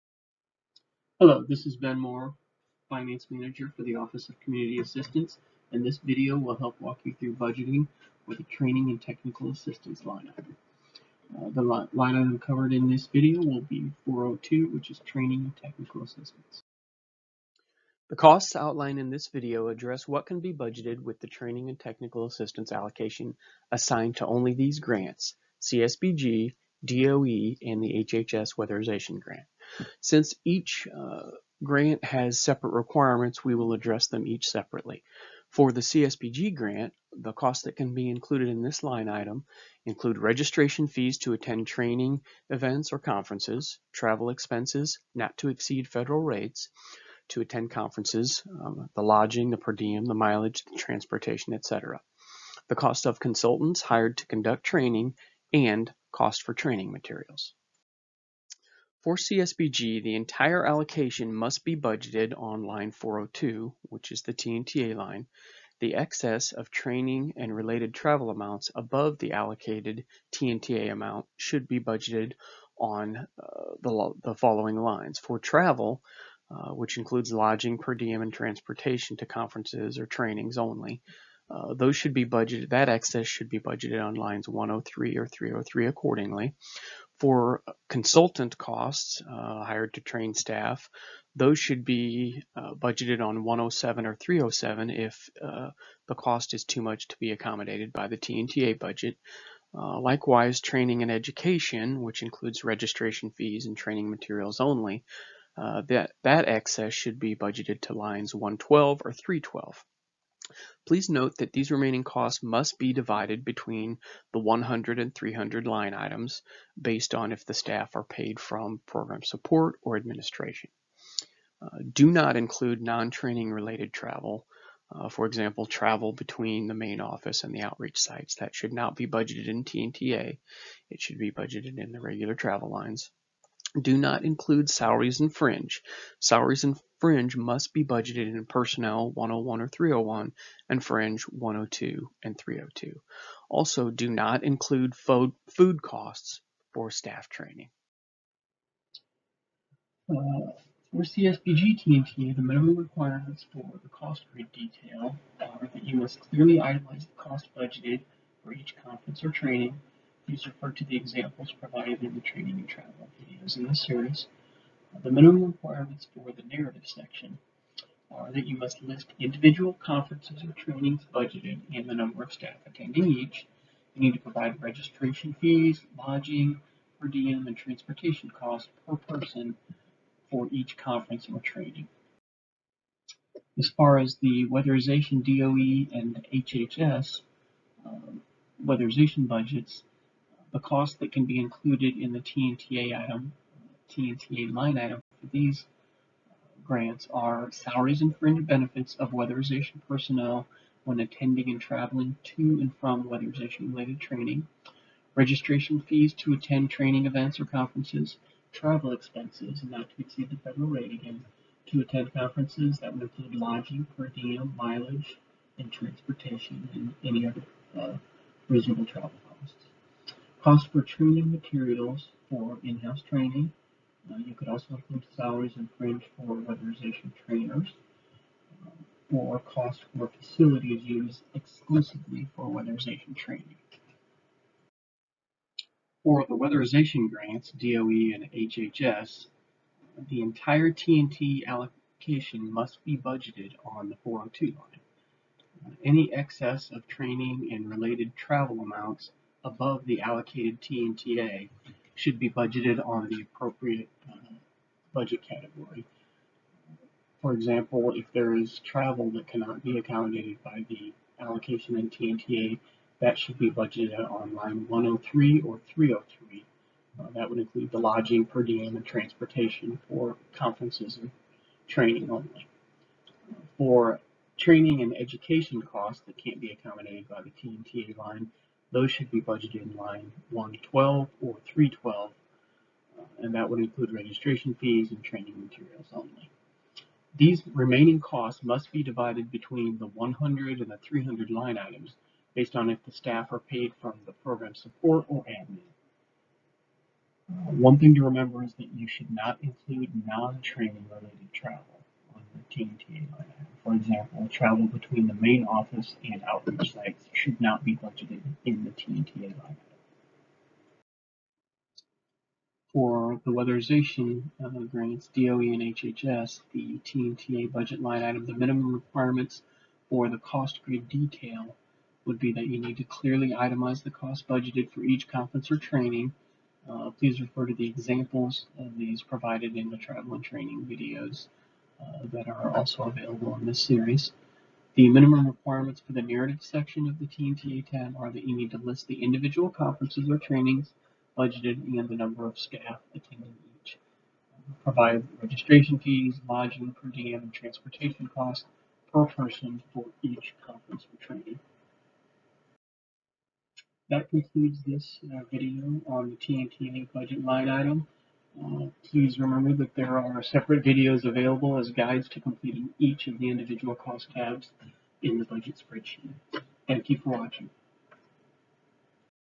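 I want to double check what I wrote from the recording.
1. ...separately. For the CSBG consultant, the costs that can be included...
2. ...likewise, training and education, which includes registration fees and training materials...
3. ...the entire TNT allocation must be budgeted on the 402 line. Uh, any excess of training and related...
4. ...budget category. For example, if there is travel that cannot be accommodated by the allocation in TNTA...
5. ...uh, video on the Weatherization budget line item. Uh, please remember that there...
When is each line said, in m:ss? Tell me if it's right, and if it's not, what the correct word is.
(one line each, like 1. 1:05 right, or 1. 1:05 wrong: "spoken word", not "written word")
1. 0:34 wrong: "grant", not "consultant"
2. 1:39 right
3. 4:00 right
4. 4:14 right
5. 5:55 wrong: "TNTA", not "Weatherization".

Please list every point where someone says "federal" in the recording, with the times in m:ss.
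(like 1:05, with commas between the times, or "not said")
0:45, 3:30.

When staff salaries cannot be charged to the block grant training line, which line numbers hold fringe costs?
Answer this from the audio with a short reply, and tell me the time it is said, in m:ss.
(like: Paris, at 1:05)
102 and 302, at 2:21.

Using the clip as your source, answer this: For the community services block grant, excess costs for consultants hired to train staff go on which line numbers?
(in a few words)
107 or 307.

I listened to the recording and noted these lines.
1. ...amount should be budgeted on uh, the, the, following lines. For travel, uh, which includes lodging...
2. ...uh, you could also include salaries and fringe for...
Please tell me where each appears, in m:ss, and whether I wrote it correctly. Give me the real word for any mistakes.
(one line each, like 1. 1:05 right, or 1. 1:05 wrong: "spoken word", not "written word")
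1. 1:10 right
2. 3:44 right.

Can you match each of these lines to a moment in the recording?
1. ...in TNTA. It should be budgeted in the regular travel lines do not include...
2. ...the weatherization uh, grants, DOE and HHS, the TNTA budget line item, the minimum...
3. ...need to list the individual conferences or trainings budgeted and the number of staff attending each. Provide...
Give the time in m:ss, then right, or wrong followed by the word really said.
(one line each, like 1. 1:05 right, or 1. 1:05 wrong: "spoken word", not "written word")
1. 2:09 right
2. 5:13 right
3. 5:38 right.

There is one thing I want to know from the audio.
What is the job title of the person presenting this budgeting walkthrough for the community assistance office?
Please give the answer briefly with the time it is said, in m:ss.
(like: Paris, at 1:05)
Finance Manager, at 0:02.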